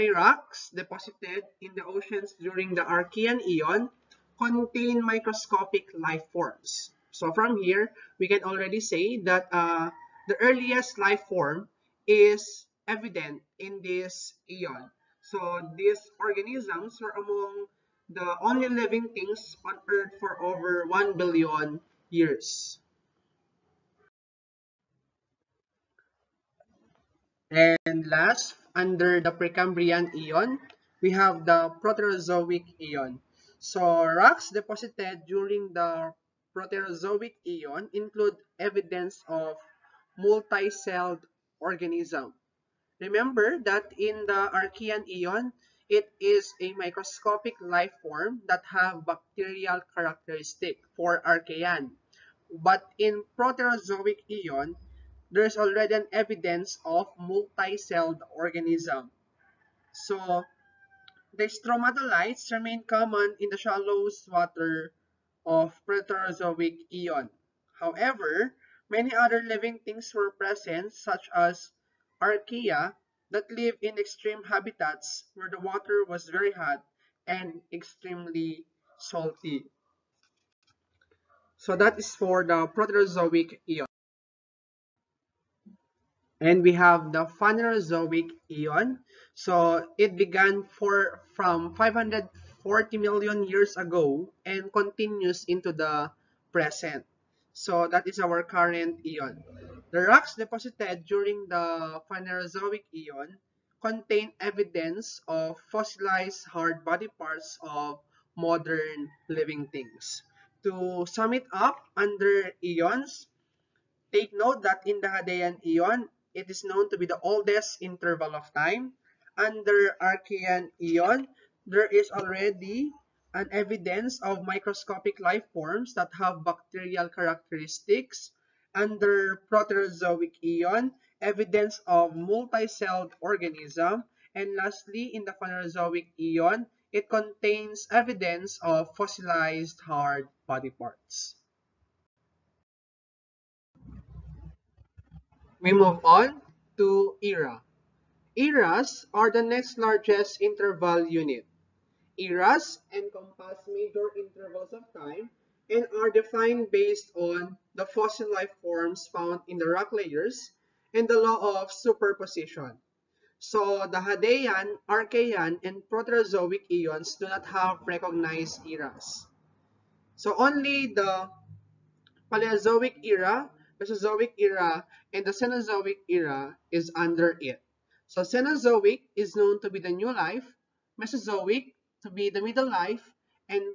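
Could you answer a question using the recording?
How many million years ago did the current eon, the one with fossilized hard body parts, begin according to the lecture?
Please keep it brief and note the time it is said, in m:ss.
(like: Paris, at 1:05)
540, at 1:31.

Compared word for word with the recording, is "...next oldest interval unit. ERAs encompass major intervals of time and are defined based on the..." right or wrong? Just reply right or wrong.
wrong.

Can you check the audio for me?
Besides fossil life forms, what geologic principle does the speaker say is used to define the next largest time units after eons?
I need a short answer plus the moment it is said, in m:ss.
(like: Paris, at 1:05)
law of superposition, at 2:41.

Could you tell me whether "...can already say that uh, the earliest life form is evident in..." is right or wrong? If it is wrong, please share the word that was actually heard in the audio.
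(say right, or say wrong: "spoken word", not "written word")
right.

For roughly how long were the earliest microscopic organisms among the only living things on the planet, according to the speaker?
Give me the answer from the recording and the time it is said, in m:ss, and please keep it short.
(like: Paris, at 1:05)
over 1 billion years, at 0:20.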